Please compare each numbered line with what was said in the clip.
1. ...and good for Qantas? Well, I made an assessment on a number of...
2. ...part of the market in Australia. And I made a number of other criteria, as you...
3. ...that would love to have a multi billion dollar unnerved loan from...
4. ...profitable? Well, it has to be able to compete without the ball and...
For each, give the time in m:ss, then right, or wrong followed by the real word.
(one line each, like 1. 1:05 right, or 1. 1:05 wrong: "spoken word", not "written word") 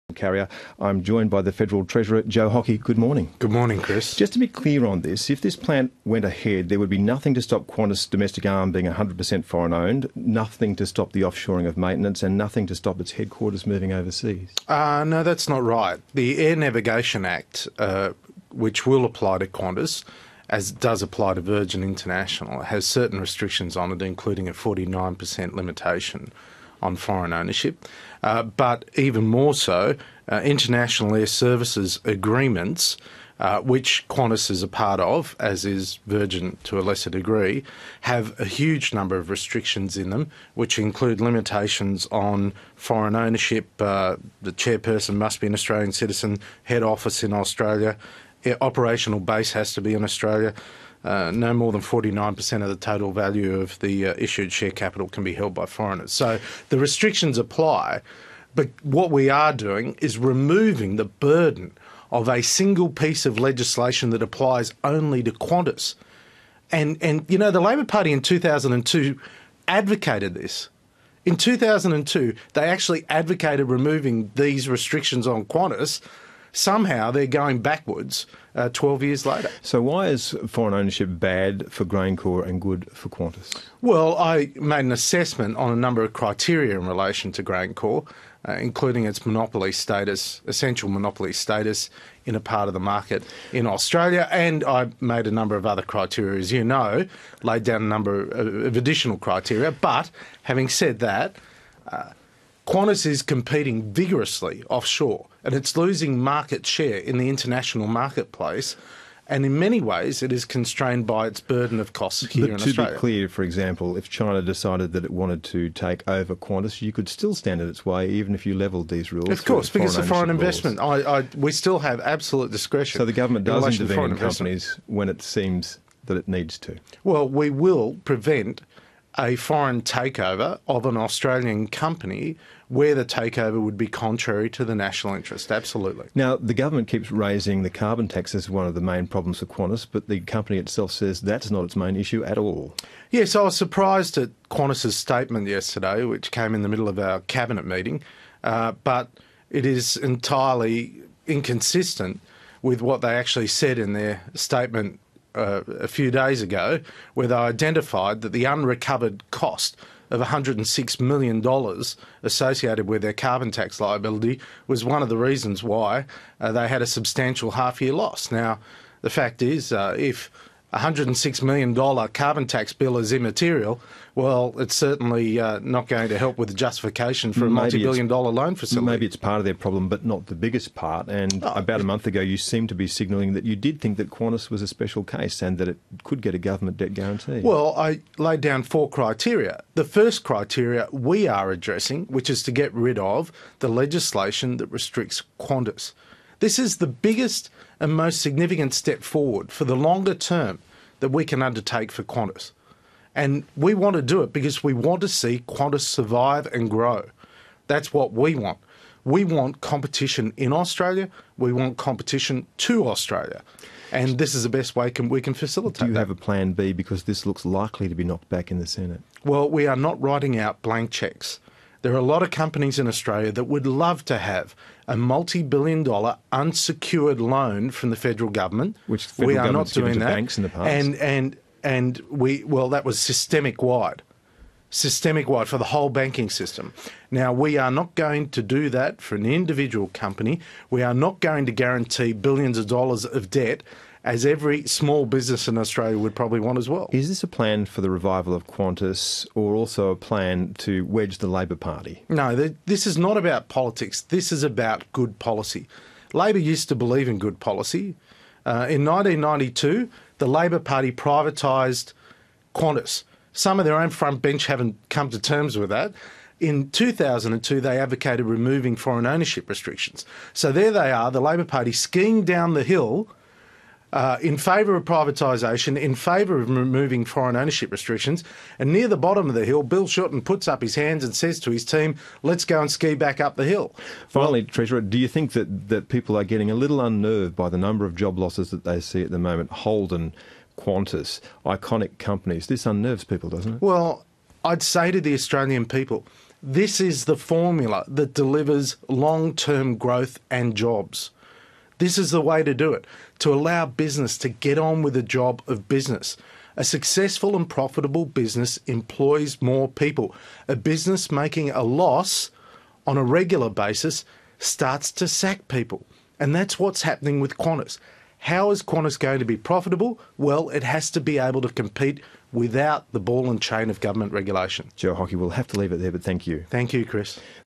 1. 1:22 right
2. 1:32 right
3. 3:43 wrong: "unsecured", not "unnerved"
4. 5:19 right.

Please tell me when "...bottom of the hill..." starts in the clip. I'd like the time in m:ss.
4:38.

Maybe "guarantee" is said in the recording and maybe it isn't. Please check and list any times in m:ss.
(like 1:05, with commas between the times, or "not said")
3:06, 4:01.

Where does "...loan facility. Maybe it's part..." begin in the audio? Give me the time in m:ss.
2:58.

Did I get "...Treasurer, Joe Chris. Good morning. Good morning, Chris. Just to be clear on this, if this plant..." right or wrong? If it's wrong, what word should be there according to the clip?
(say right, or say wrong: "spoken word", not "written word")
wrong: "Hockey", not "Chris".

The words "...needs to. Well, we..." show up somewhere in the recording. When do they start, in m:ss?
2:06.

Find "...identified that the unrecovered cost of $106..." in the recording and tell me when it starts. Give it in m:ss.
2:37.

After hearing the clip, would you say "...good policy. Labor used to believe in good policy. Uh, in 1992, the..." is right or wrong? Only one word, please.
right.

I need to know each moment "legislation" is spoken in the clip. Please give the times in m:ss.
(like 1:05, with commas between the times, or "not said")
1:03, 3:13.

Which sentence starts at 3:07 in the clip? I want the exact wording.
Well, I laid down four criteria.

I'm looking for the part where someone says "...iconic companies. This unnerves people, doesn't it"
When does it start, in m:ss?
4:51.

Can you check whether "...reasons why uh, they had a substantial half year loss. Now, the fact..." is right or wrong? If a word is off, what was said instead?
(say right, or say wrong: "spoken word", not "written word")
right.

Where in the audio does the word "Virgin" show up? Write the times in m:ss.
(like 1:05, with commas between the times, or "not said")
0:21, 0:36.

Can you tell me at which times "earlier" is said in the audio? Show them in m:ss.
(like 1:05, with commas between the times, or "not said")
not said.